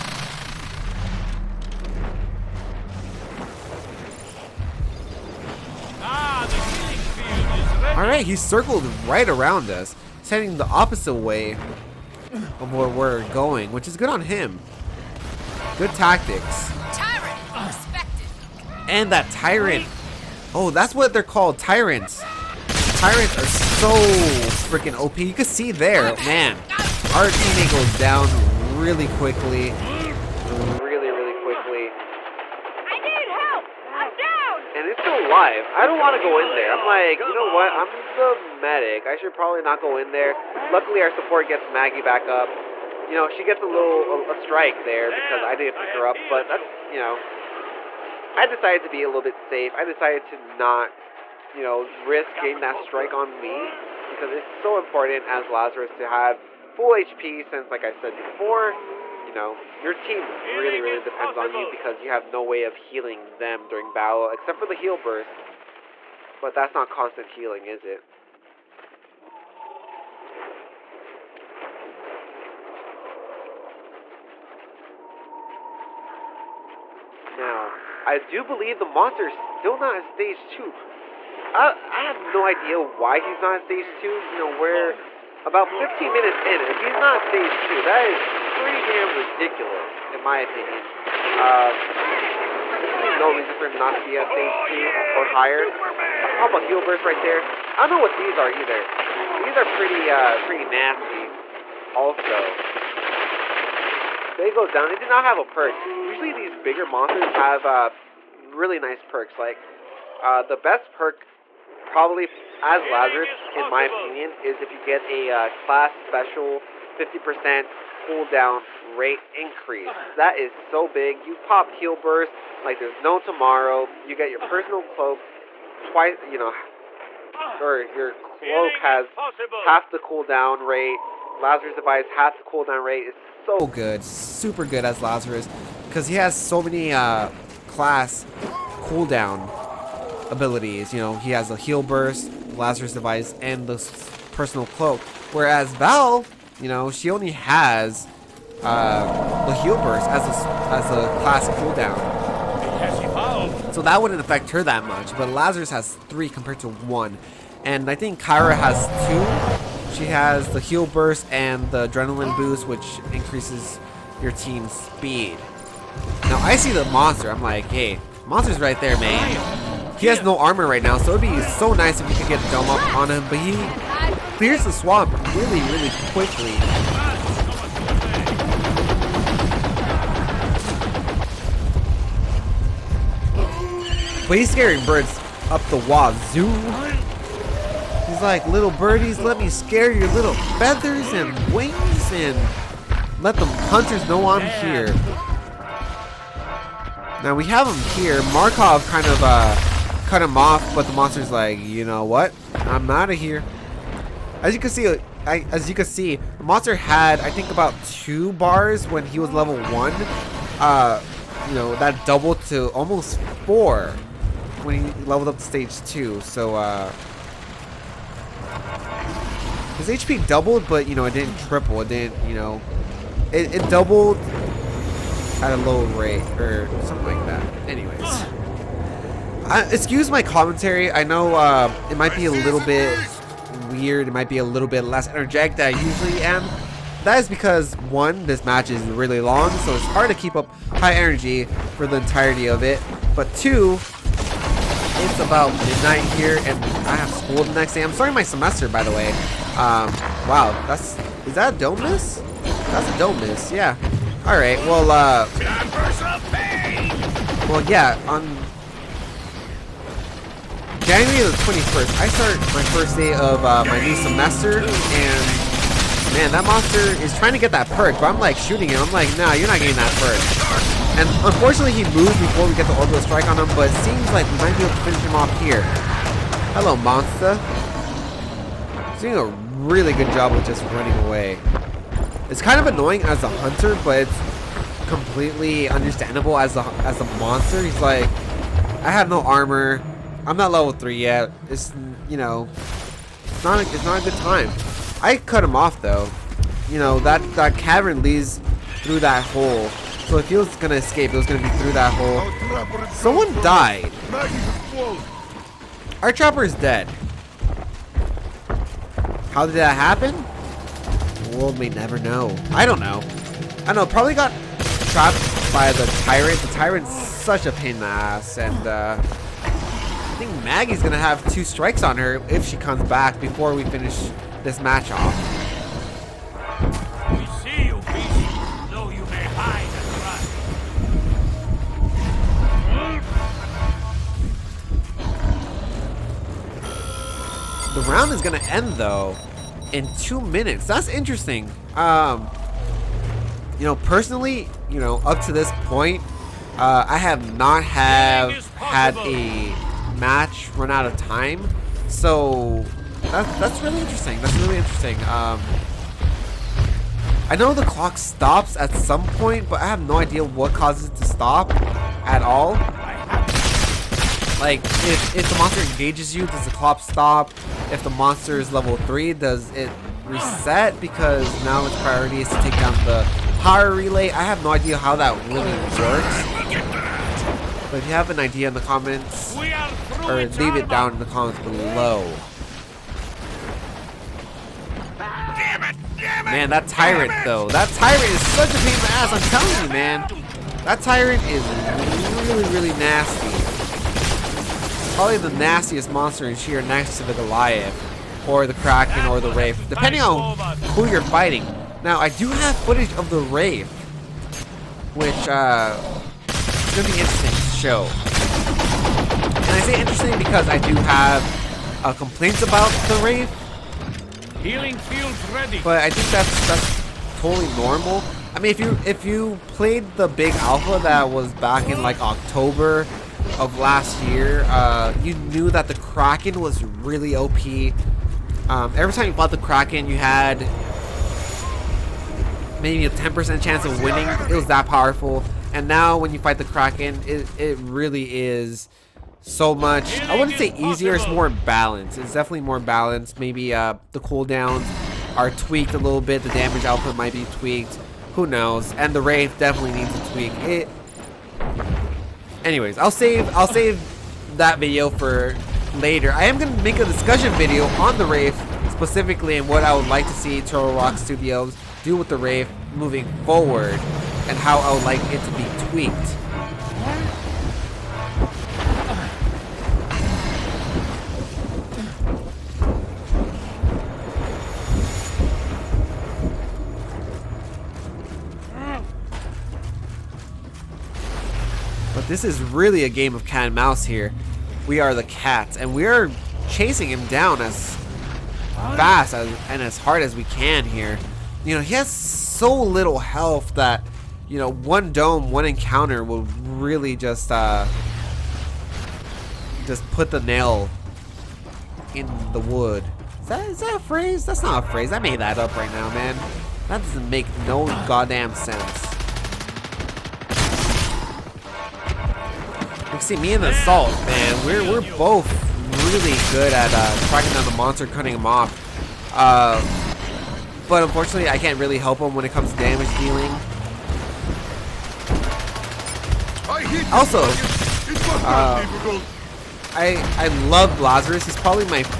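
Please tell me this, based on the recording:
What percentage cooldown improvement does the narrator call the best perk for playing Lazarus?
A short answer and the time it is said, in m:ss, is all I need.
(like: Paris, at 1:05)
50%, at 1:56.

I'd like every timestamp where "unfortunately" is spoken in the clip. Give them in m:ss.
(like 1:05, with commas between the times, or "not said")
4:31, 8:40.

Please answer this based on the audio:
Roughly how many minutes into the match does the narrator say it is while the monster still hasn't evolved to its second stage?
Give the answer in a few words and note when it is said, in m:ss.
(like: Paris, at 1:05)
15, at 1:25.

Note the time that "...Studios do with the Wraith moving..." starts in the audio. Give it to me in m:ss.
7:40.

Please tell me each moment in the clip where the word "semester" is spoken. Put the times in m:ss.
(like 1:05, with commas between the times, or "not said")
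4:08, 4:23.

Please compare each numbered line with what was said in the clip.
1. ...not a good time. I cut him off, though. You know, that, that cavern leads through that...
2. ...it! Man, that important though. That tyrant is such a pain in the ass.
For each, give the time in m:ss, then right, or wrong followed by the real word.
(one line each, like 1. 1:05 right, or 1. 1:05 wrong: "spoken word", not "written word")
1. 4:53 right
2. 6:25 wrong: "tyrant", not "important".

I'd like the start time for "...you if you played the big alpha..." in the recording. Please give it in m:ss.
6:58.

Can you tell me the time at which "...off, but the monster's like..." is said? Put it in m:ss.
3:20.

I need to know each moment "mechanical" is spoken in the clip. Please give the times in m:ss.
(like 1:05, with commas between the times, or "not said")
not said.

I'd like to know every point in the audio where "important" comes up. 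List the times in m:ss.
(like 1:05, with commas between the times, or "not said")
0:54.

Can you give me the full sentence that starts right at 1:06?
But that's not constant healing, is it?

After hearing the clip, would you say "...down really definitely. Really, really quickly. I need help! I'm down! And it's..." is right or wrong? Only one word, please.
wrong.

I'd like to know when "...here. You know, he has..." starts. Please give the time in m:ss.
8:10.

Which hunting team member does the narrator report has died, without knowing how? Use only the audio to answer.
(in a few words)
Our chopper.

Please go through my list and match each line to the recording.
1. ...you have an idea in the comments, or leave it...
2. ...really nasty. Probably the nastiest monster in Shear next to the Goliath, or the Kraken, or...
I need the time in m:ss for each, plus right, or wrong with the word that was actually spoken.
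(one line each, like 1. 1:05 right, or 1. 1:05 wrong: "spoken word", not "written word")
1. 6:17 right
2. 6:32 right.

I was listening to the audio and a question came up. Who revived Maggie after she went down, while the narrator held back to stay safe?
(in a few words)
Our support.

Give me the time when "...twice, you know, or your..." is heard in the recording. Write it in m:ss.
2:05.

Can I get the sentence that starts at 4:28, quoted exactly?
I'm like, nah, you're not getting that perk.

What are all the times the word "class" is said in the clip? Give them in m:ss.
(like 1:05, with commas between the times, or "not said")
1:55, 2:17, 2:31.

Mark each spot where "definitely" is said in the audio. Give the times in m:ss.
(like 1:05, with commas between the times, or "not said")
7:22, 7:29.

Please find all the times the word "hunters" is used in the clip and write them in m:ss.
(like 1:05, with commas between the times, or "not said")
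3:13, 4:43.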